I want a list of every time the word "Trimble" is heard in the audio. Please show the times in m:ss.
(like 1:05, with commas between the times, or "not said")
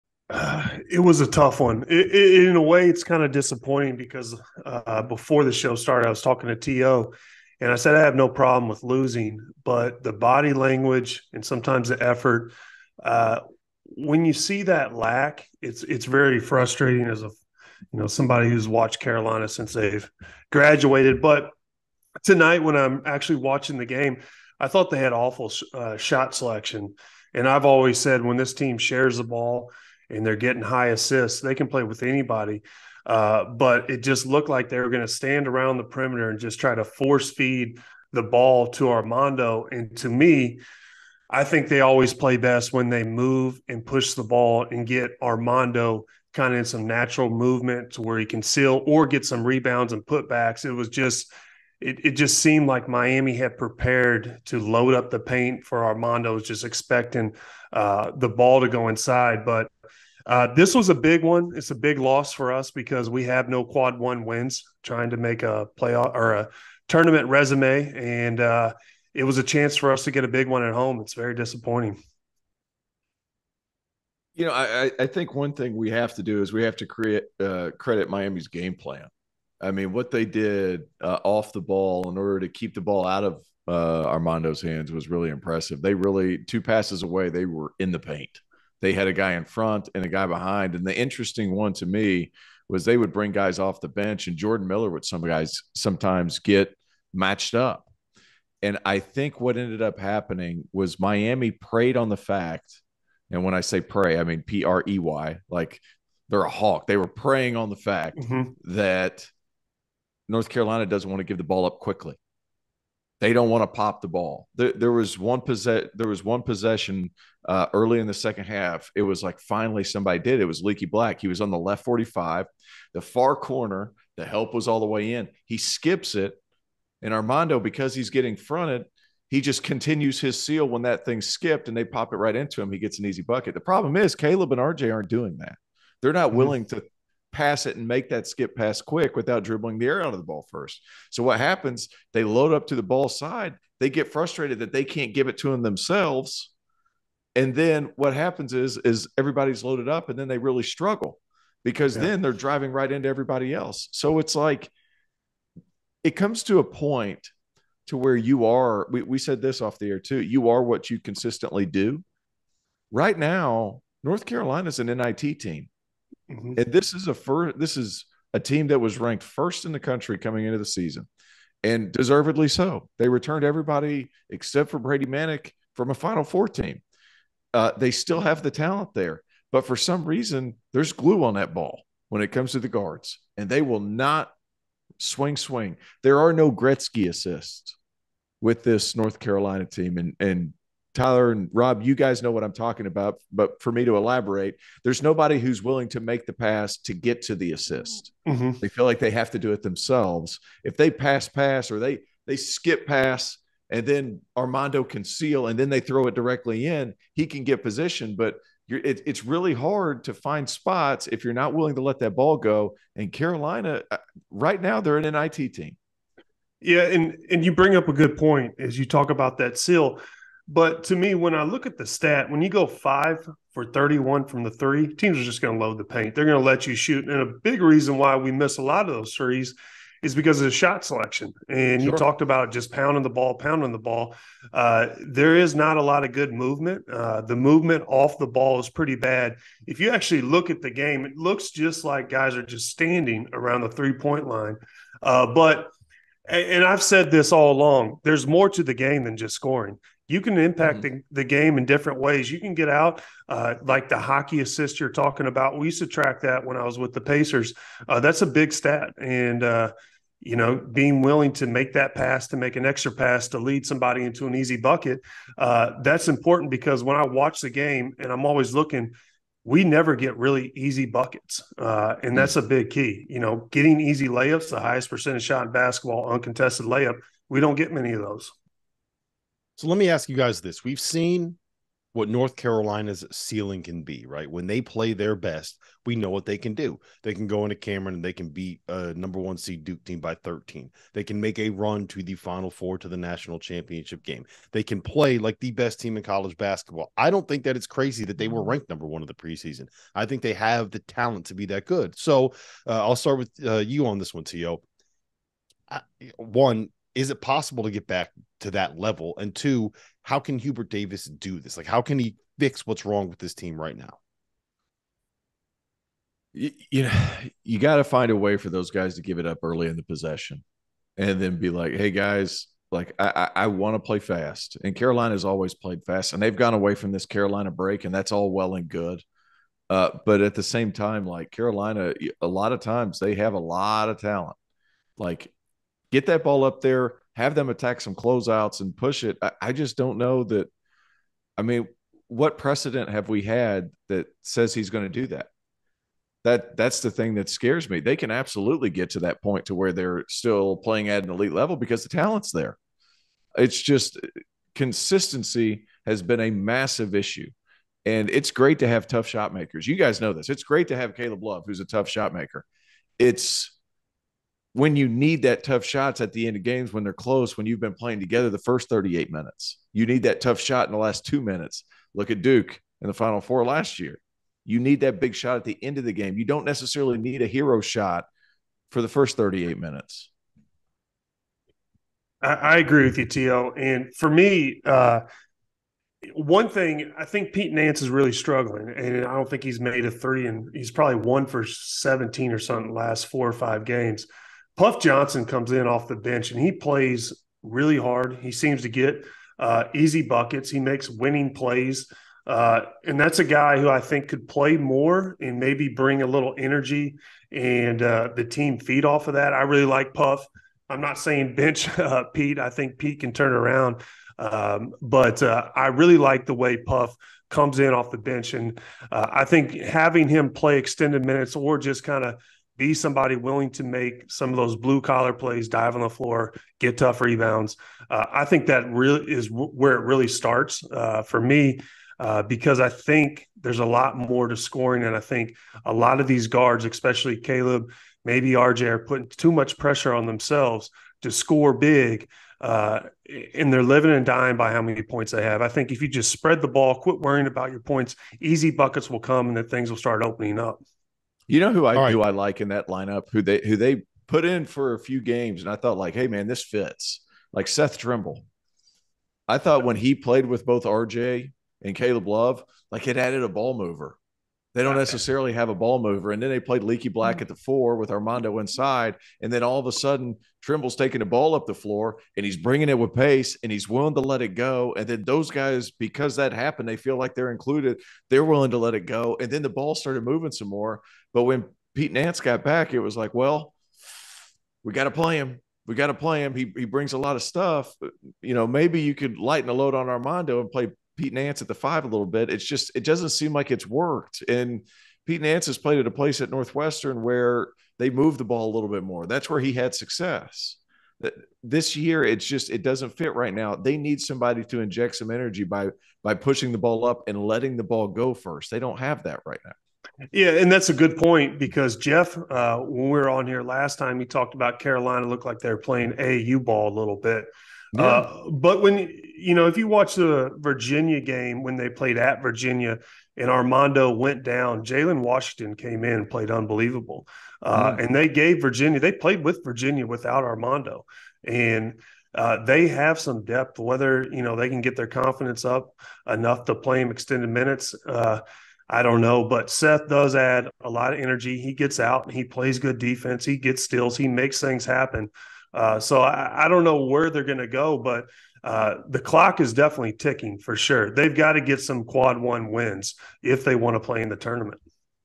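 7:37, 7:50.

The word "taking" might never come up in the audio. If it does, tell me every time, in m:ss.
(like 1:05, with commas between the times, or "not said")
7:50.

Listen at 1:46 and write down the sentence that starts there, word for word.
They were preying on the fact mm-hmm.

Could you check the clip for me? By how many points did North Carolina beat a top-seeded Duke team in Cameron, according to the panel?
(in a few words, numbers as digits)
13.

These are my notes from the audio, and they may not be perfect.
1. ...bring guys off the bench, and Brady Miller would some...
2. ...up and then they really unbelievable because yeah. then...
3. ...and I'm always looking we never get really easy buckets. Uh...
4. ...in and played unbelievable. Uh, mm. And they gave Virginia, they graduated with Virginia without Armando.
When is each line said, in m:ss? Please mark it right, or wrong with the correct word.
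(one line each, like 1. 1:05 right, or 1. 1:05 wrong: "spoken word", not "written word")
1. 1:33 wrong: "Jordan", not "Brady"
2. 2:29 wrong: "struggle", not "unbelievable"
3. 4:27 right
4. 8:45 wrong: "played", not "graduated".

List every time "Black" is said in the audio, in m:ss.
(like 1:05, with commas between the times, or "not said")
2:00, 7:46.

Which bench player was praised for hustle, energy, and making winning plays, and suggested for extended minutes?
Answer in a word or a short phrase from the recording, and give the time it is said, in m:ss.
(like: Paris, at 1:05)
Puff Johnson, at 6:34.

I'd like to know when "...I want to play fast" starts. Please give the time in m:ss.
5:23.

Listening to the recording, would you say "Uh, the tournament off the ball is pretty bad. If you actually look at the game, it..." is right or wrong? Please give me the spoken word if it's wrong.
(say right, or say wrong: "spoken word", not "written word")
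wrong: "movement", not "tournament".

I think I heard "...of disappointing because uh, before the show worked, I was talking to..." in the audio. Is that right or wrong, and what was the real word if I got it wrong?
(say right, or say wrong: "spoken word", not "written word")
wrong: "started", not "worked".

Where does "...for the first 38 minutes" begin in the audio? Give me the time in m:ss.
6:18.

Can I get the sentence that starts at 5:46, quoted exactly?
That that's the thing that scares me.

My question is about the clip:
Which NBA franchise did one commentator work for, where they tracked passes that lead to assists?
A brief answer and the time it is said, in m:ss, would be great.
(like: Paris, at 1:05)
Pacers, at 4:17.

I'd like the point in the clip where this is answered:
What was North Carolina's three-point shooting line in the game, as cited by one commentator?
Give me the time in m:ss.
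3:42.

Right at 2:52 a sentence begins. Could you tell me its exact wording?
They returned everybody except for Brady Manek from a Final Four team.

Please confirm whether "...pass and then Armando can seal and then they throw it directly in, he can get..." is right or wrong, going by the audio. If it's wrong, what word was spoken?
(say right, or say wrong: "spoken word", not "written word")
right.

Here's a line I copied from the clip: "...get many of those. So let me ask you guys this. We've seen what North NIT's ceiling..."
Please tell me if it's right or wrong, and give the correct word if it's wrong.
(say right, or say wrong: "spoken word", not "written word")
wrong: "Carolina", not "NIT".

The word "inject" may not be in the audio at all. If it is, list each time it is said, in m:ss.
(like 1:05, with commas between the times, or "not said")
8:24.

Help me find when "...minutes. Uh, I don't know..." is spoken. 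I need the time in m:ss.
8:57.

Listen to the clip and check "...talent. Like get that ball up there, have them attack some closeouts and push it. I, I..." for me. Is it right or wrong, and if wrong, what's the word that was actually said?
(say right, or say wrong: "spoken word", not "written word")
right.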